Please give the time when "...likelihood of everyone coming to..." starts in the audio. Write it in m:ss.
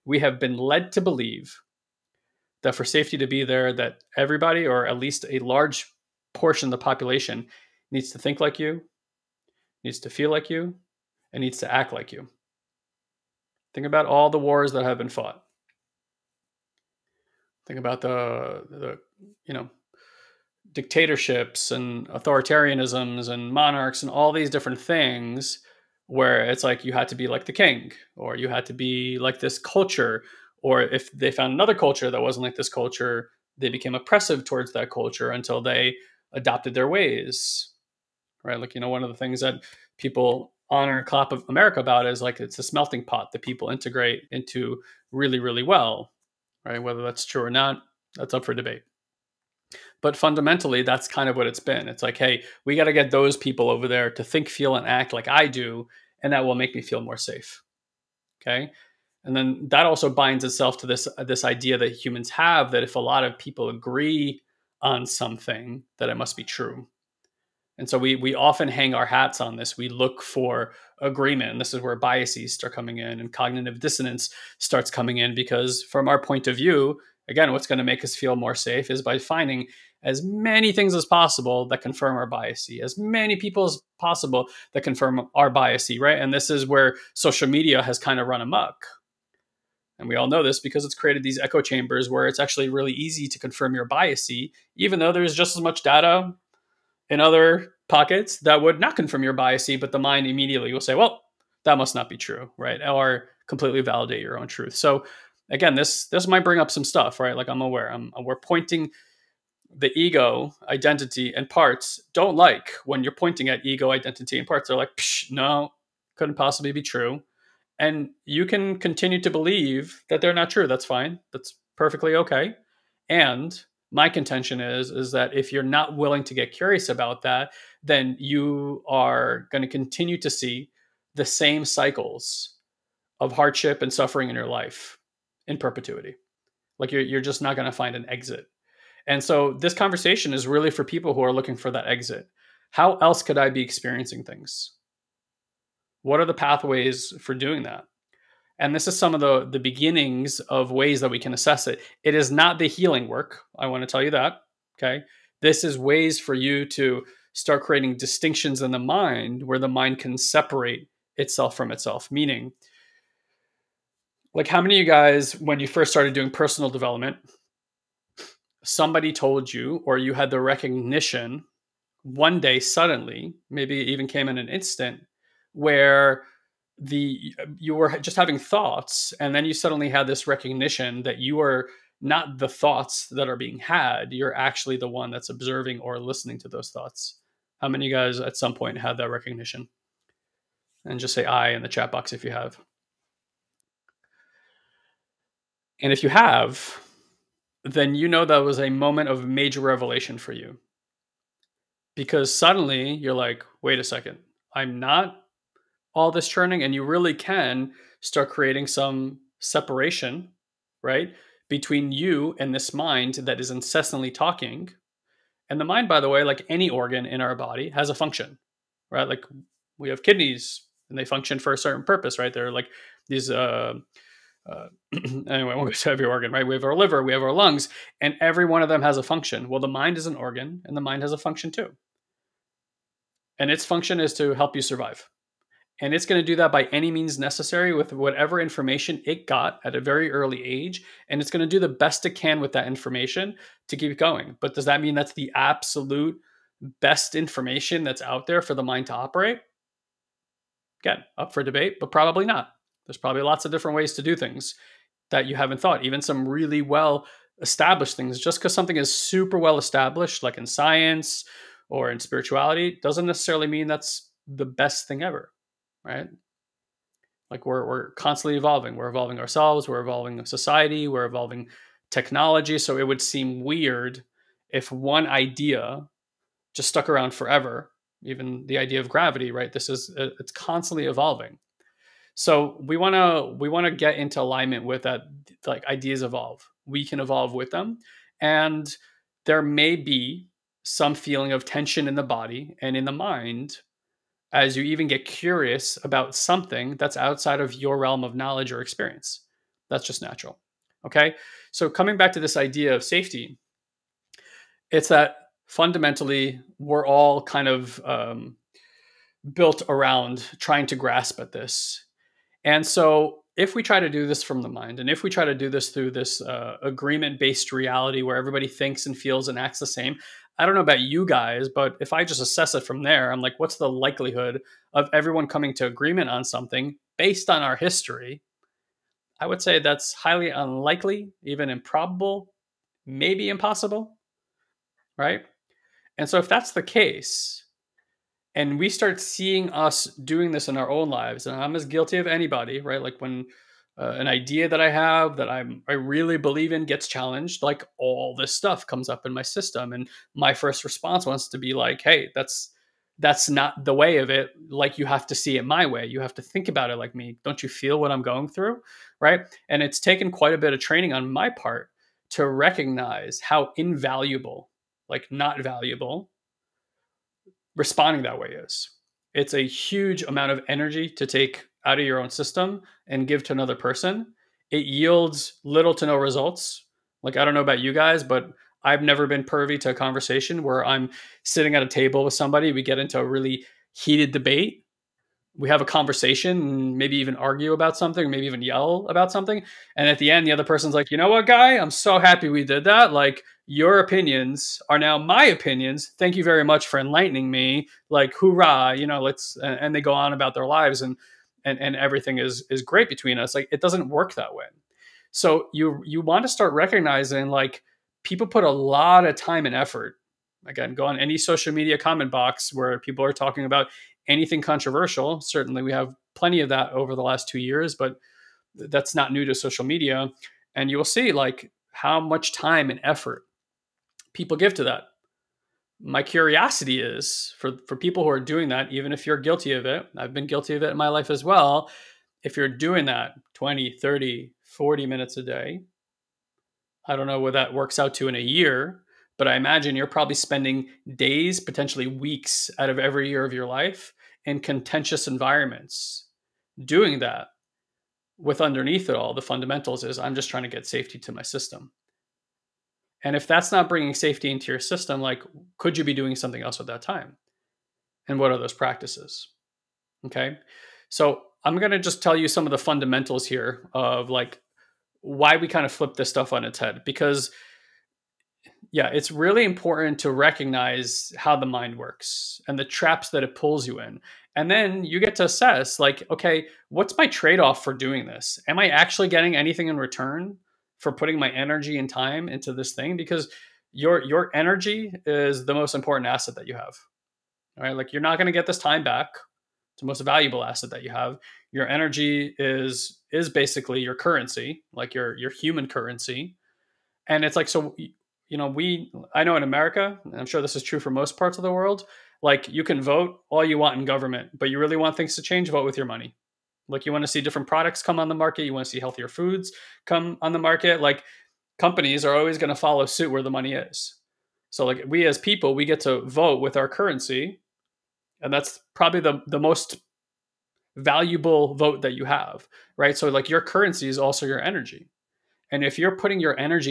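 5:23.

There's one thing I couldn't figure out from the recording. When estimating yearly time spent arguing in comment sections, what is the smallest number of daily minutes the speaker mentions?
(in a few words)
20.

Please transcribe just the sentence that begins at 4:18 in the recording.
Just because something is super well established, like in science or in spirituality, doesn't necessarily mean that's the best thing ever, right?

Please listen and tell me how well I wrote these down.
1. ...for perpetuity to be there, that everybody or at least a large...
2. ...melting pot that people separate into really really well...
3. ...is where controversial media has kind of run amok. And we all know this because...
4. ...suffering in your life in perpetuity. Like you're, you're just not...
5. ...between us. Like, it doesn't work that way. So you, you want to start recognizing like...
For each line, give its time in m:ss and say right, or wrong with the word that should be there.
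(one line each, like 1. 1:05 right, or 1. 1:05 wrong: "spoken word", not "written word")
1. 0:02 wrong: "safety", not "perpetuity"
2. 0:42 wrong: "integrate", not "separate"
3. 1:26 wrong: "social", not "controversial"
4. 2:13 right
5. 6:42 right.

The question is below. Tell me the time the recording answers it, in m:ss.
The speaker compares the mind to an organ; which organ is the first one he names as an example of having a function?
3:40.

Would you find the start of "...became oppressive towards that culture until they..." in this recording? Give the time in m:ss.
0:33.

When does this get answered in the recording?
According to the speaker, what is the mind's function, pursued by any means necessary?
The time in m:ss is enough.
3:54.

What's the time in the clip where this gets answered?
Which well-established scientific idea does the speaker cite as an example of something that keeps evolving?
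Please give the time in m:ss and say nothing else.
4:38.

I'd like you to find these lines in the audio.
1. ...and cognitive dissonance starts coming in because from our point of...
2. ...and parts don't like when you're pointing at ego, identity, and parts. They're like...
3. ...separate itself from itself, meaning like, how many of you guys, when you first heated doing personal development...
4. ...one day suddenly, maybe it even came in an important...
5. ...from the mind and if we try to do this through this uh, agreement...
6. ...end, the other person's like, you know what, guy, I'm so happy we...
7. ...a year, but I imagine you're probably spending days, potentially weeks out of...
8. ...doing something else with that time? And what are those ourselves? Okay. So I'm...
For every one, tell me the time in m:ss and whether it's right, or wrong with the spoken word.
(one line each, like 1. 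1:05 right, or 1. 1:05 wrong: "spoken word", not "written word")
1. 1:13 right
2. 1:51 right
3. 2:40 wrong: "started", not "heated"
4. 2:52 wrong: "instant", not "important"
5. 5:14 right
6. 6:30 right
7. 7:18 right
8. 7:35 wrong: "practices", not "ourselves".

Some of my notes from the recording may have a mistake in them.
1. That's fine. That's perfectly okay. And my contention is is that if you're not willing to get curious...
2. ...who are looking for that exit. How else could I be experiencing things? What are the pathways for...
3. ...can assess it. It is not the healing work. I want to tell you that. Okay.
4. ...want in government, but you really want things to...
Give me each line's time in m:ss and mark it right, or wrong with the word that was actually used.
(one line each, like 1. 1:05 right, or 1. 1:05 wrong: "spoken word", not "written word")
1. 2:00 right
2. 2:21 right
3. 2:31 right
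4. 8:23 right.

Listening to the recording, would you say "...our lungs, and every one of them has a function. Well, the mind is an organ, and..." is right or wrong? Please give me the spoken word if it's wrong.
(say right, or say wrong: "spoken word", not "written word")
right.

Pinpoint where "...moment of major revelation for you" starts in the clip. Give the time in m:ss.
3:18.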